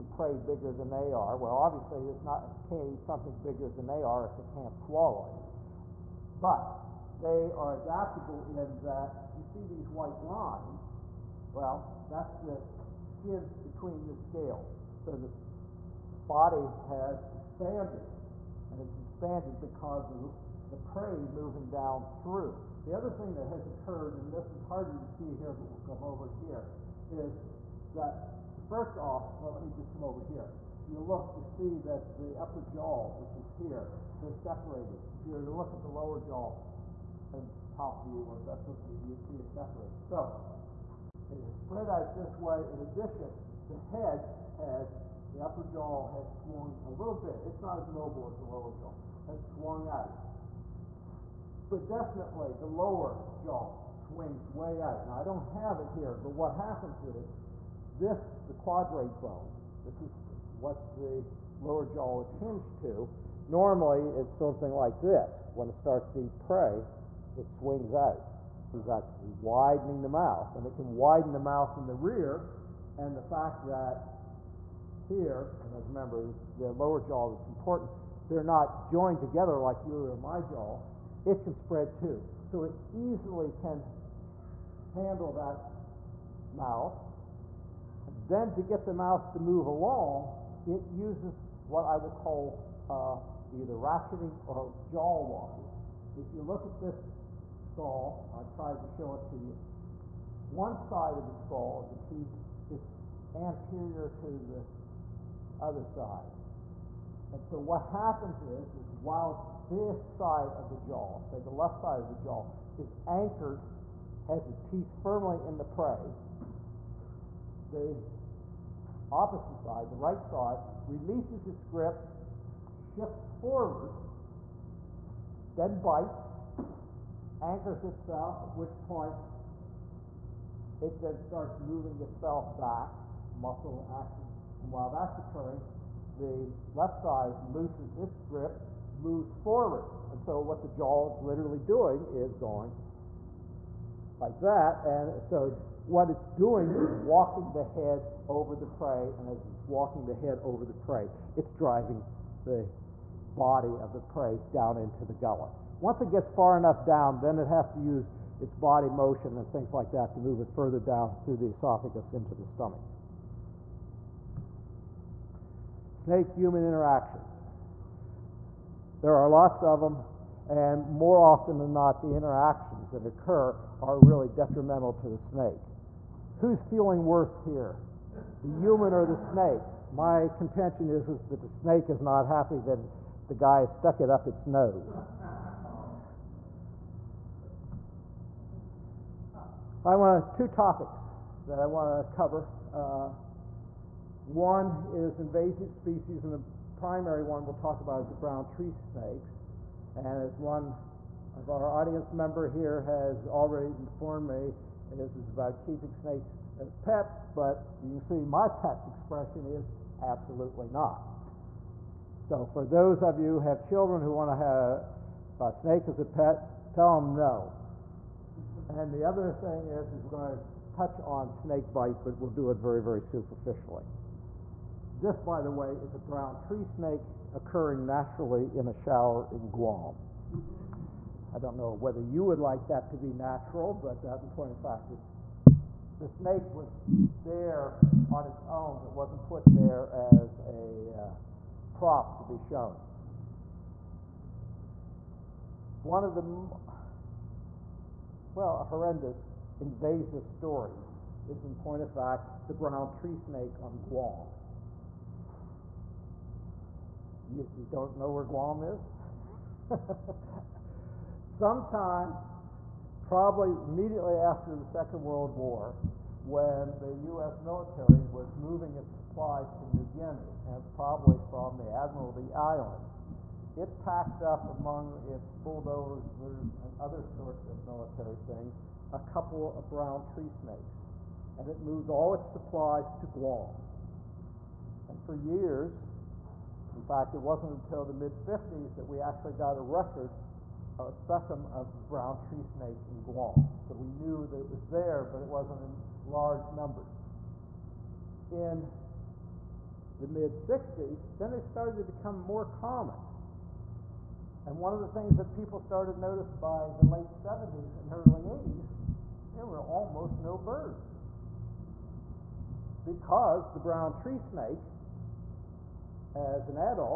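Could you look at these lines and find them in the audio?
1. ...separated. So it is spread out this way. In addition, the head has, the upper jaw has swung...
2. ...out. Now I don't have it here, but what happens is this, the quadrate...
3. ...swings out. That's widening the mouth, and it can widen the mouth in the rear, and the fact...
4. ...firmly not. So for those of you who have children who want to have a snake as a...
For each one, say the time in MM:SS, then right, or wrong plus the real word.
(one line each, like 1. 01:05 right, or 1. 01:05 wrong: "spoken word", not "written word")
1. 00:39 right
2. 00:54 right
3. 01:07 right
4. 03:30 wrong: "absolutely", not "firmly".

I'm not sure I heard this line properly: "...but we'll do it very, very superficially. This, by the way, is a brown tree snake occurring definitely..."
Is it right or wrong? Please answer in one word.
wrong.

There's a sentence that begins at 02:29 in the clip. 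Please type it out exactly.
And as it's walking the head over the prey, it's driving the body of the prey down into the gullet.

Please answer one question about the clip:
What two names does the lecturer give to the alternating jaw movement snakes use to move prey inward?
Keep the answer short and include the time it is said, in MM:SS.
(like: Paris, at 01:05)
ratcheting or jaw walking, at 01:33.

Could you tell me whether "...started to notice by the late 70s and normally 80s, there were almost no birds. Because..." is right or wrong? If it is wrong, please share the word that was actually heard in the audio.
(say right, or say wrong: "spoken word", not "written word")
wrong: "early", not "normally".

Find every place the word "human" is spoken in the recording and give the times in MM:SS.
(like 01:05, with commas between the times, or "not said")
02:46, 02:58.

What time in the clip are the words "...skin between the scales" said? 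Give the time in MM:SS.
00:13.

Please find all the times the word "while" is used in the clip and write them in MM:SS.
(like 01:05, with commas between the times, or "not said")
01:49, 02:14.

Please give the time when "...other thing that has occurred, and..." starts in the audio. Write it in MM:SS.
00:22.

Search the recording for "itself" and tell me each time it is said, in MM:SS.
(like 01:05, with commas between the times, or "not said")
02:07, 02:11.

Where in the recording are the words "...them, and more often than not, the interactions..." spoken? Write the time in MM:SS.
02:49.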